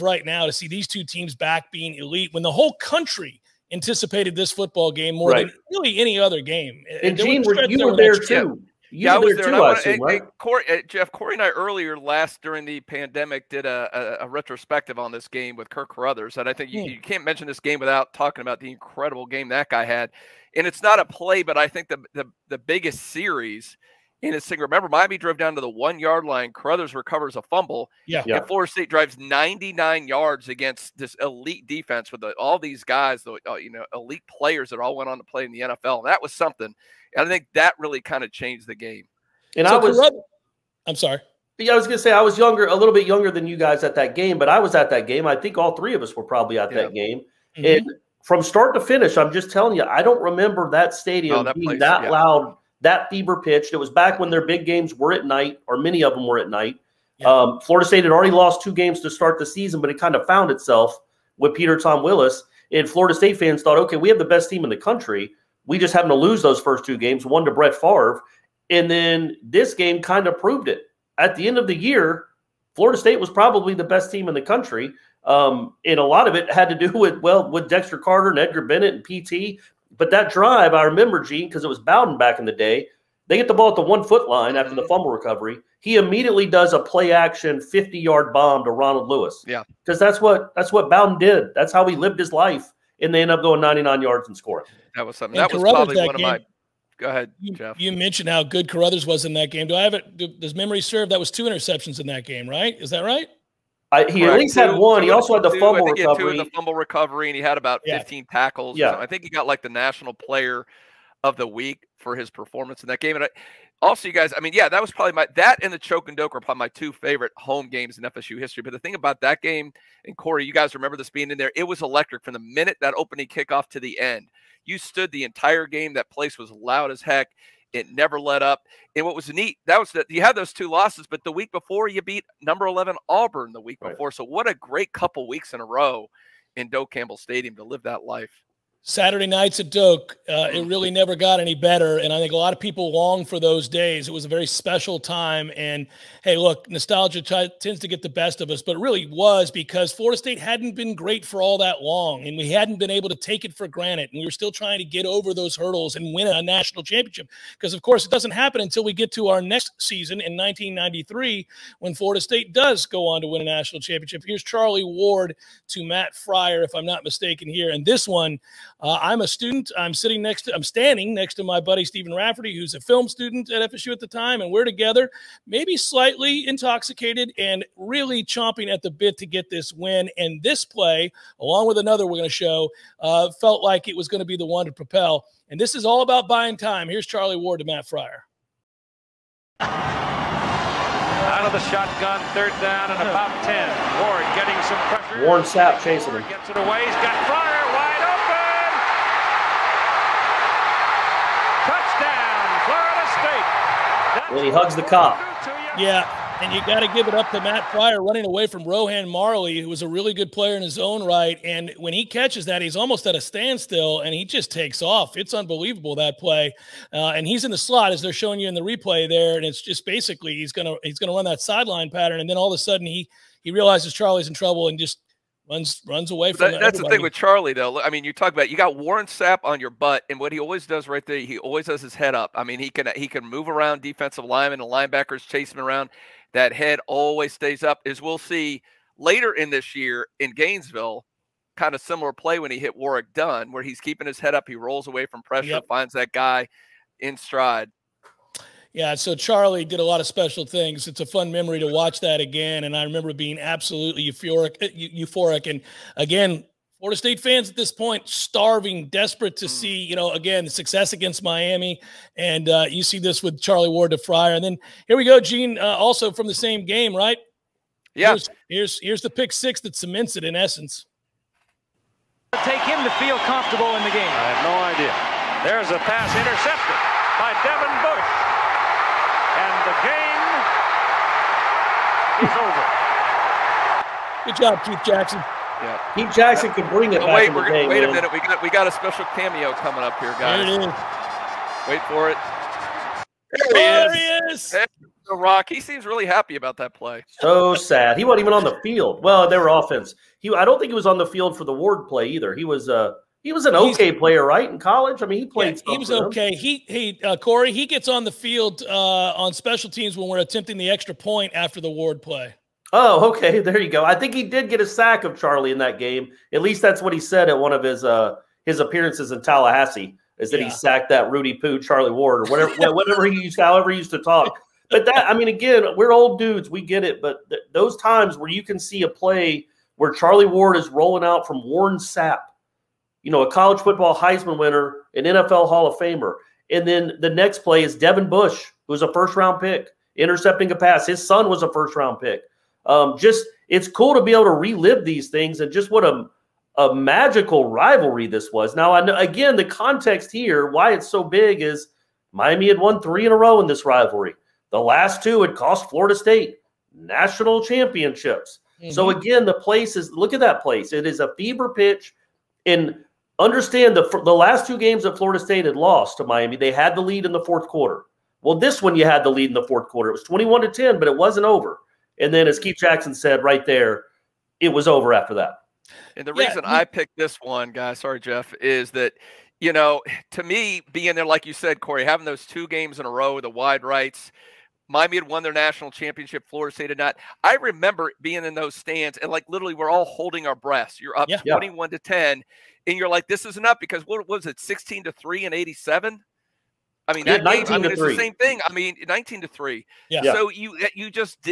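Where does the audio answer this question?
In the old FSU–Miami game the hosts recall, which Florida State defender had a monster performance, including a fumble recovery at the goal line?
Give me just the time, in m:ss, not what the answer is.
0:15.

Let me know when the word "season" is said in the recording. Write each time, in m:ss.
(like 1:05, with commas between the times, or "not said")
0:59, 2:39.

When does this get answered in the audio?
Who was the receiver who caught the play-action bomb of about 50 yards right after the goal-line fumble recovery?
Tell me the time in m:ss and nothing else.
1:28.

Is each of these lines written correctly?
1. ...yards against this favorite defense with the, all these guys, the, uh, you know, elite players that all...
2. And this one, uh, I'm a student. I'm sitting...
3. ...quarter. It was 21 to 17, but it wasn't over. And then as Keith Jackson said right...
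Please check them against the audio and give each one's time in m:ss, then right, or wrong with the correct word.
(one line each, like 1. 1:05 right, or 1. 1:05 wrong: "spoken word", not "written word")
1. 0:30 wrong: "elite", not "favorite"
2. 2:47 right
3. 6:09 wrong: "10", not "17".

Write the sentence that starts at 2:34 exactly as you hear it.
And we were still trying to get over those hurdles and win a national championship.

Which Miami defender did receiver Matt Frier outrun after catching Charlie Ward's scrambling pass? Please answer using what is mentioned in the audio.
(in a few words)
Rohan Marley.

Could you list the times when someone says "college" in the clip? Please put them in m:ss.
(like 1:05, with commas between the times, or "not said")
5:04, 5:33.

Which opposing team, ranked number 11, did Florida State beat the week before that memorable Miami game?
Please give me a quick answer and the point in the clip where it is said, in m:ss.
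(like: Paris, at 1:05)
Auburn, at 2:13.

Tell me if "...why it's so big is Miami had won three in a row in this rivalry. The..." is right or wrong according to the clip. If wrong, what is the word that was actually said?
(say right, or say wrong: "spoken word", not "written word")
right.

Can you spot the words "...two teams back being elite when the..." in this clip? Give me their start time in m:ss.
0:00.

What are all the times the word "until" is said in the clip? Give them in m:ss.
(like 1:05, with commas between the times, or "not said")
2:38.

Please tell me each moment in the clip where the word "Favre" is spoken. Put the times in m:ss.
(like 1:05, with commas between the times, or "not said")
1:07.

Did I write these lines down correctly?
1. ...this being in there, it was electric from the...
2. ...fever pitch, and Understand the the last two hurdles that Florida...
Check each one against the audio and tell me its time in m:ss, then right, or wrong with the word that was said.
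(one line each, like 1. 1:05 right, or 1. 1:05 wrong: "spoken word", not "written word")
1. 2:00 right
2. 6:01 wrong: "games", not "hurdles".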